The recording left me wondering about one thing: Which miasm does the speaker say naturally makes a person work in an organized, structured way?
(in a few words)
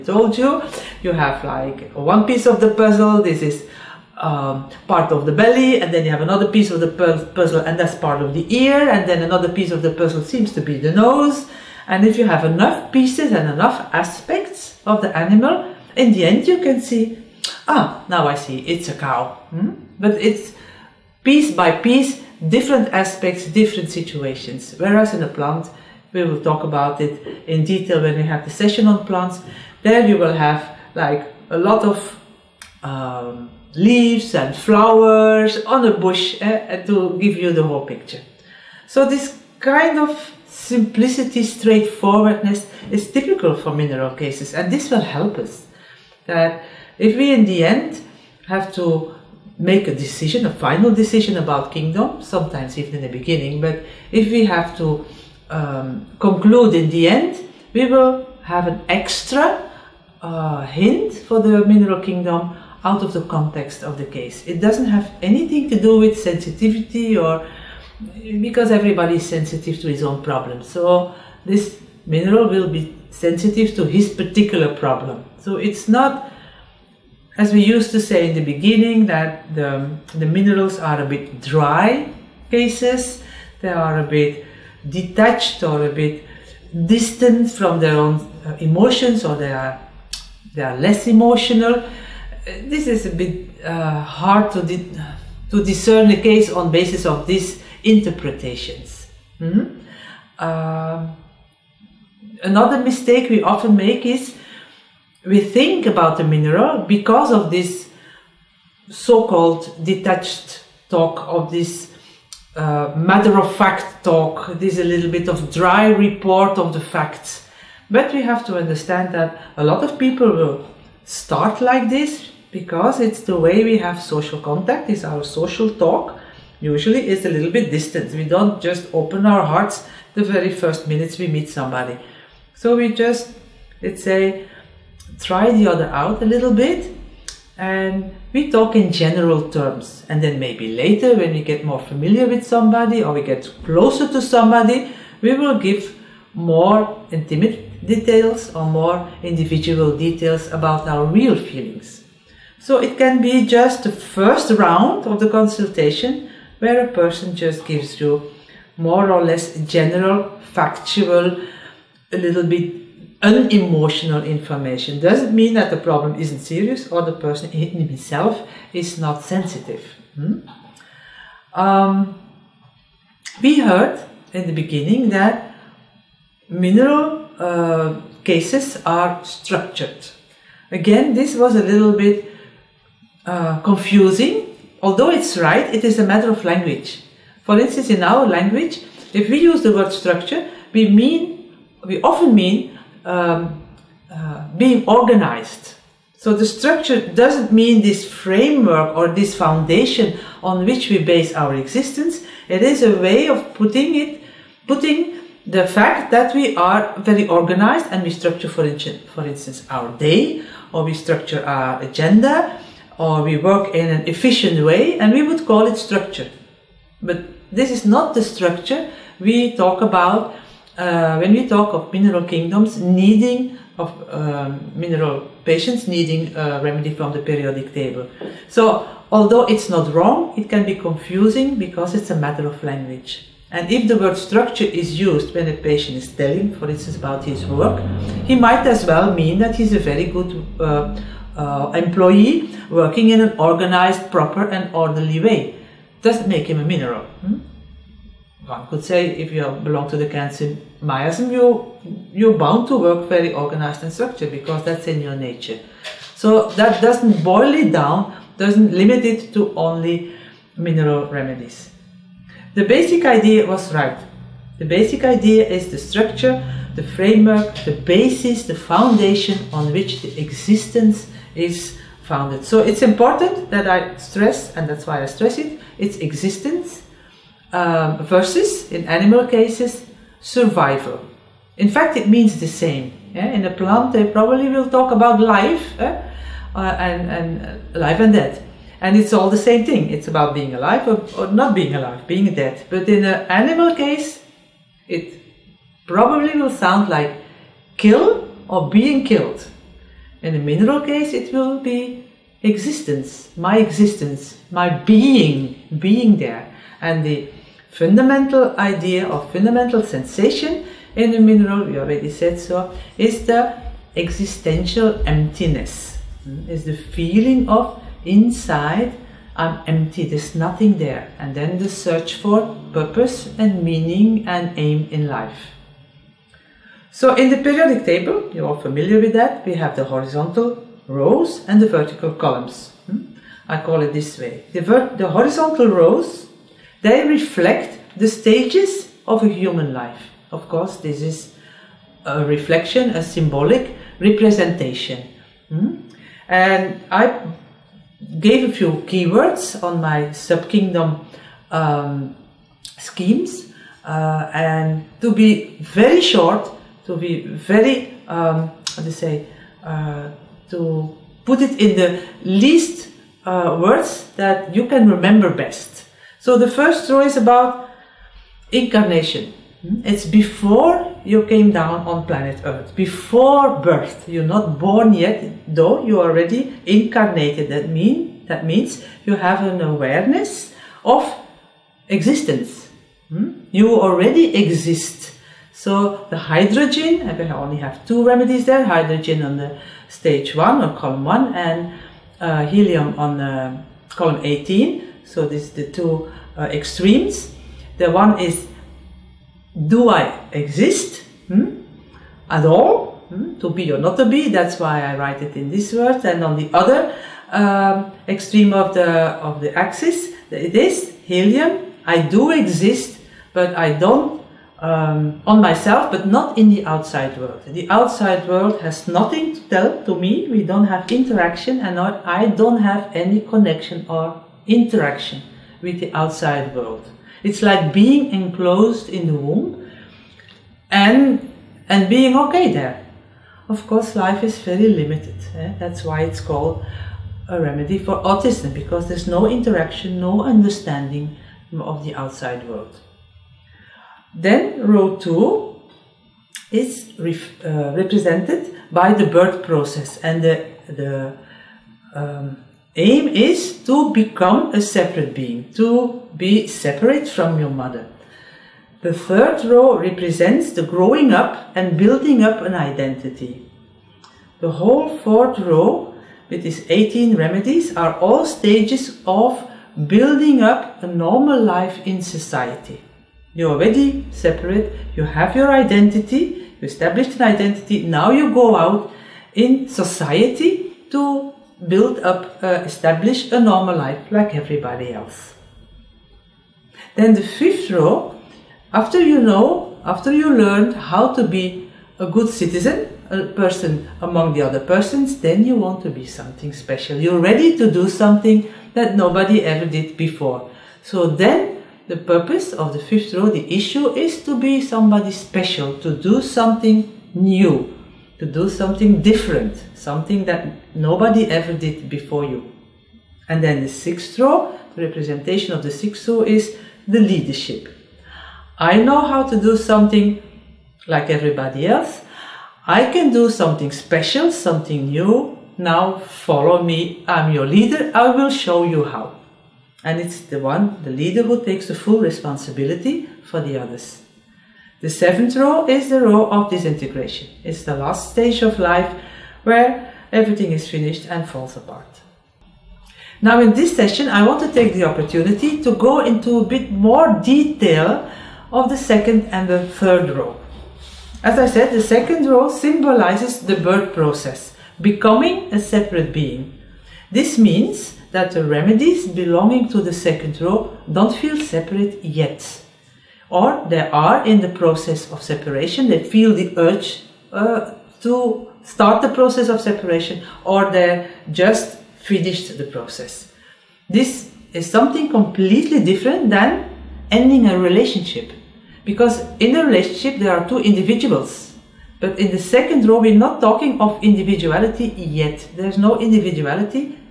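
Kantian miasm.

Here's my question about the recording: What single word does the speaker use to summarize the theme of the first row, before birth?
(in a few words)
incarnation.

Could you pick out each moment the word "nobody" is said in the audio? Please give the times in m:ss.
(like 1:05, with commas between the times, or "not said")
8:18, 8:30.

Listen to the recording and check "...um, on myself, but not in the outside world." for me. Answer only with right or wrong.
right.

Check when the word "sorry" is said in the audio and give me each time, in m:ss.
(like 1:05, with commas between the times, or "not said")
not said.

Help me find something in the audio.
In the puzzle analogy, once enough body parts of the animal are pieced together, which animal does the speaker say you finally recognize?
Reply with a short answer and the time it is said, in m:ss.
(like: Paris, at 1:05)
cow, at 0:18.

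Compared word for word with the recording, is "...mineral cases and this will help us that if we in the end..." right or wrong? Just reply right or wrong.
right.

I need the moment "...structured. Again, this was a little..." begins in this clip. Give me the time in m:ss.
2:59.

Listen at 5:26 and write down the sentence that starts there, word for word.
So in the periodic table, you're all familiar with that, we have the horizontal rows and the vertical columns.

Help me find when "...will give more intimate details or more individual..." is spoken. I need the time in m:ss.
2:25.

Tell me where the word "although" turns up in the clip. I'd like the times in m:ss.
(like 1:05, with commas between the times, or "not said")
3:04, 3:49.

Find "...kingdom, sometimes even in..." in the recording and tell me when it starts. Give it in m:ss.
0:51.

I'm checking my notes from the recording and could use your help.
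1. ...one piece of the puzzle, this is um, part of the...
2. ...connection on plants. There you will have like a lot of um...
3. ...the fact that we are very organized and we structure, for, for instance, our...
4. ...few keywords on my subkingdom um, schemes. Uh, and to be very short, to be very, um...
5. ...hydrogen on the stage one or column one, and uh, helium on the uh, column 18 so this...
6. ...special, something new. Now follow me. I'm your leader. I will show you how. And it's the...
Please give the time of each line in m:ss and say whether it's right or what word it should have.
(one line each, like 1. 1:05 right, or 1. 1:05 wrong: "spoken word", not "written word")
1. 0:01 right
2. 0:28 wrong: "session", not "connection"
3. 3:25 right
4. 5:48 right
5. 6:28 right
6. 8:43 right.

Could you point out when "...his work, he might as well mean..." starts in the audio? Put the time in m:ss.
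3:57.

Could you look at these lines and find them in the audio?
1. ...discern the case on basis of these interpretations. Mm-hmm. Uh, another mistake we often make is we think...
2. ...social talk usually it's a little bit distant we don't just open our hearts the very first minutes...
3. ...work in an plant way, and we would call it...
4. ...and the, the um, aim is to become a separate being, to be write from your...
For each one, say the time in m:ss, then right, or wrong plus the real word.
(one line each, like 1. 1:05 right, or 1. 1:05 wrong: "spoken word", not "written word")
1. 1:35 right
2. 2:05 right
3. 3:33 wrong: "efficient", not "plant"
4. 7:29 wrong: "separate", not "write".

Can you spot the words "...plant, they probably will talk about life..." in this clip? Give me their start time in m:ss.
4:43.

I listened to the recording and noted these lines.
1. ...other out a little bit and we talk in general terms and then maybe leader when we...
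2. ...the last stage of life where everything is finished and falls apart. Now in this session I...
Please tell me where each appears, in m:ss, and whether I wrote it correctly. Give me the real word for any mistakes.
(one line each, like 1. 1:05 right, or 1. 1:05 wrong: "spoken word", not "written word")
1. 2:15 wrong: "later", not "leader"
2. 8:57 right.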